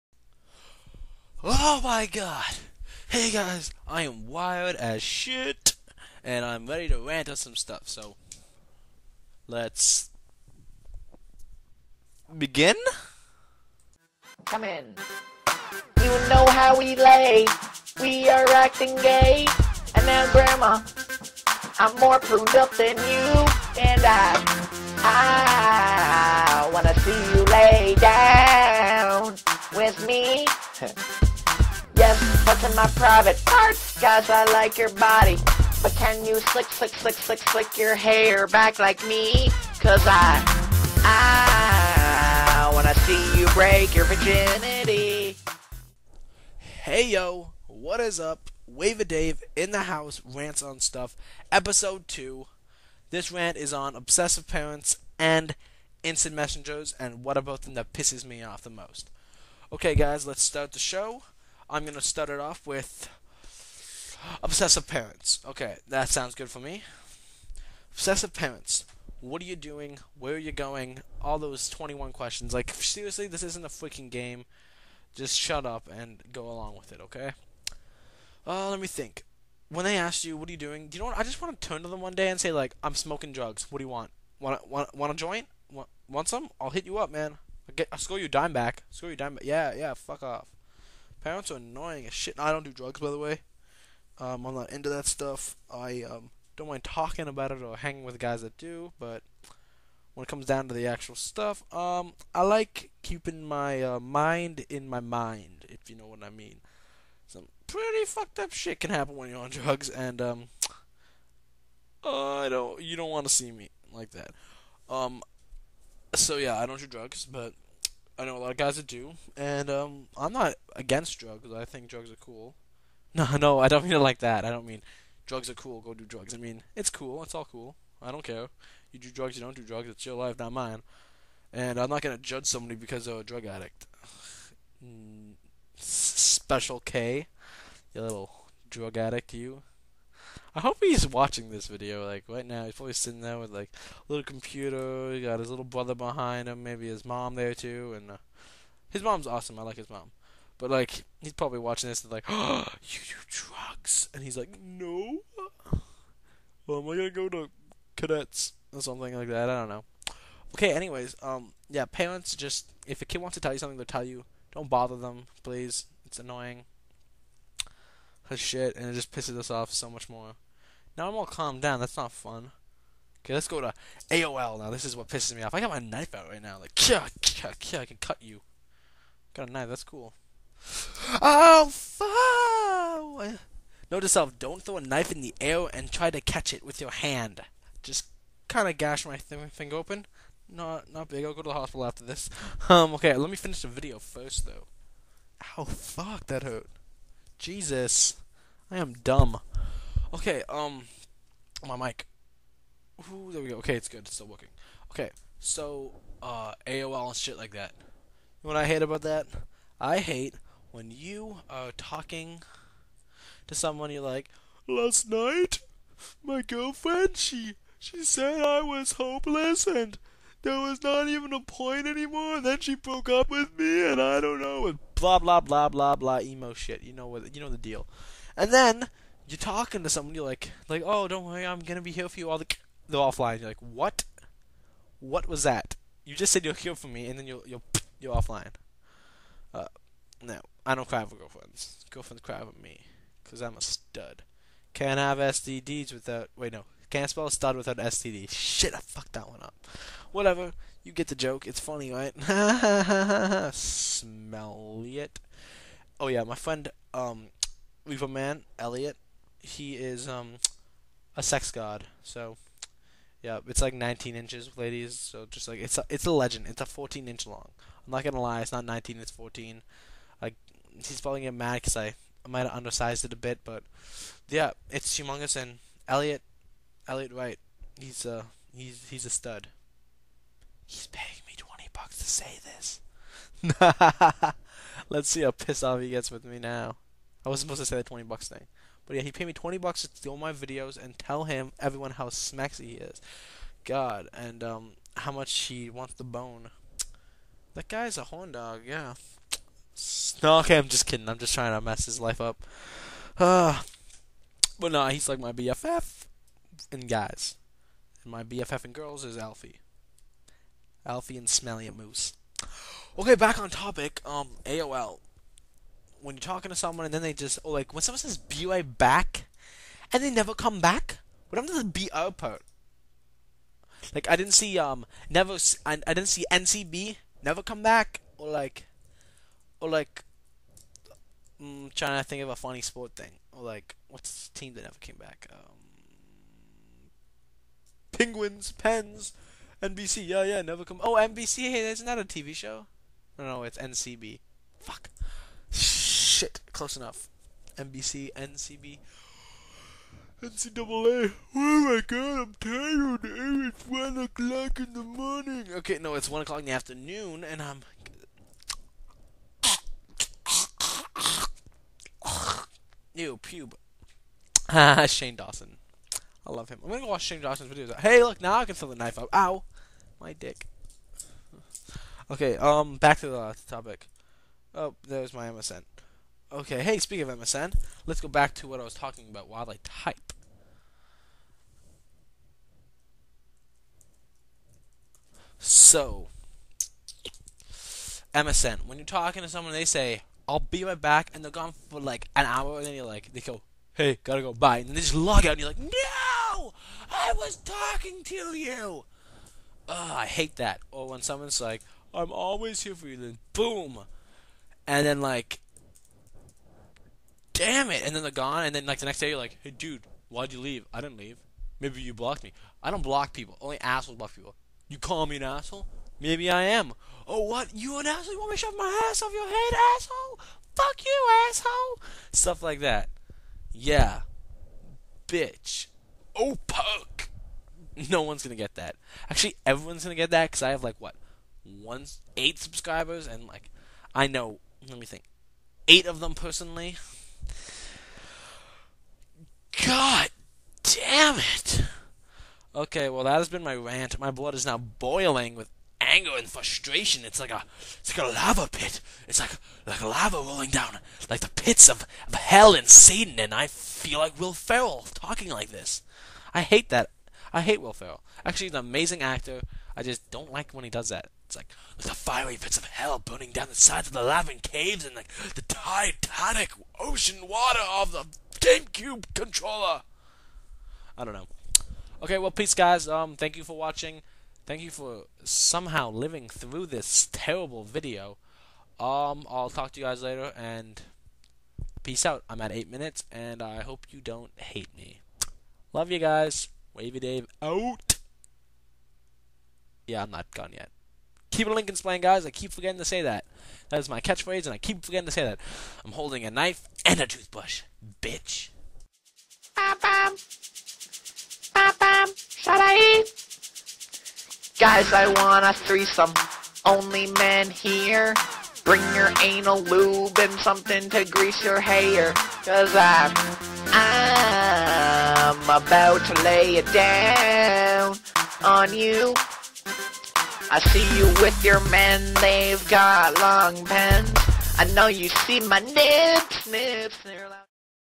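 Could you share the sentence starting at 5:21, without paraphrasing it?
What happened to the BO part?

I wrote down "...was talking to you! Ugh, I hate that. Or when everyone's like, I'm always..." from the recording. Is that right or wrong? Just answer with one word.
wrong.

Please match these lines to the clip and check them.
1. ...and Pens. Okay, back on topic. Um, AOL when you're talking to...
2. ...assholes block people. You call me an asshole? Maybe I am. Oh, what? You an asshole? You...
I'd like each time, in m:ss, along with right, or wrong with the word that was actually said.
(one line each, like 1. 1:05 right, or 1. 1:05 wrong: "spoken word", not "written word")
1. 5:11 wrong: "Moose", not "Pens"
2. 6:53 right.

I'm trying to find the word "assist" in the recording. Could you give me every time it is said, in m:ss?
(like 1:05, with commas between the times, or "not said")
not said.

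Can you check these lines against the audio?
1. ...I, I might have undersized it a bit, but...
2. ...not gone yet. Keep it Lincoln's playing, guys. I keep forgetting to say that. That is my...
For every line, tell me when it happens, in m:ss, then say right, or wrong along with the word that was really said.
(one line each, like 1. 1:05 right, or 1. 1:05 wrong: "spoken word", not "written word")
1. 4:31 right
2. 8:10 right.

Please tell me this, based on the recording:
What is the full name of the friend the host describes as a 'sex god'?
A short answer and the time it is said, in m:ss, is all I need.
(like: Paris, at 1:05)
Elliot Wright, at 4:36.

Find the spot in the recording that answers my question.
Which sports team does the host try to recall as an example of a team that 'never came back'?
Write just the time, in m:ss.
5:37.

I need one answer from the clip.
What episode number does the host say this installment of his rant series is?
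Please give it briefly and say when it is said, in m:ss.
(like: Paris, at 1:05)
2, at 0:51.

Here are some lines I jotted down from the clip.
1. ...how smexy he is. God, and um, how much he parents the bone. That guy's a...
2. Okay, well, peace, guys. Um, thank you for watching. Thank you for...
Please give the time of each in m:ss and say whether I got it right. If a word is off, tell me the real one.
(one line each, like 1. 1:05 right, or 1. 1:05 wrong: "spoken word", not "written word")
1. 4:51 wrong: "wants", not "parents"
2. 7:52 right.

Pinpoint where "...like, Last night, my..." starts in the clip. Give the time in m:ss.
3:34.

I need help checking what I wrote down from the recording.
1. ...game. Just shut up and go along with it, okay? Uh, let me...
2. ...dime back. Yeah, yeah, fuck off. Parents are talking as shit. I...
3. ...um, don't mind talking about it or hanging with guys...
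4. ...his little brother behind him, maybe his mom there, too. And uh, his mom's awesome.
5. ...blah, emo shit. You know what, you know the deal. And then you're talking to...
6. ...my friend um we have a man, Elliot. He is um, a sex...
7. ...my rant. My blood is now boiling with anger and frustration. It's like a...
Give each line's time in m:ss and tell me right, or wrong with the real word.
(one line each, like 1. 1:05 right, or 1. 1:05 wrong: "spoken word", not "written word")
1. 1:14 right
2. 1:29 wrong: "annoying", not "talking"
3. 1:36 right
4. 2:25 right
5. 3:45 right
6. 4:16 right
7. 7:23 right.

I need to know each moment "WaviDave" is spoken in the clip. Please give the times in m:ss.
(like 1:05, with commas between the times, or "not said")
0:48, 8:06.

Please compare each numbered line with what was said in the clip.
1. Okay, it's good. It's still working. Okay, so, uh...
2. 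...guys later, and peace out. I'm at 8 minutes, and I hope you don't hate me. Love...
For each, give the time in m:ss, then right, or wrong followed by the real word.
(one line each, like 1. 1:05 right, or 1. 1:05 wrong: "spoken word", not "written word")
1. 3:23 right
2. 7:59 right.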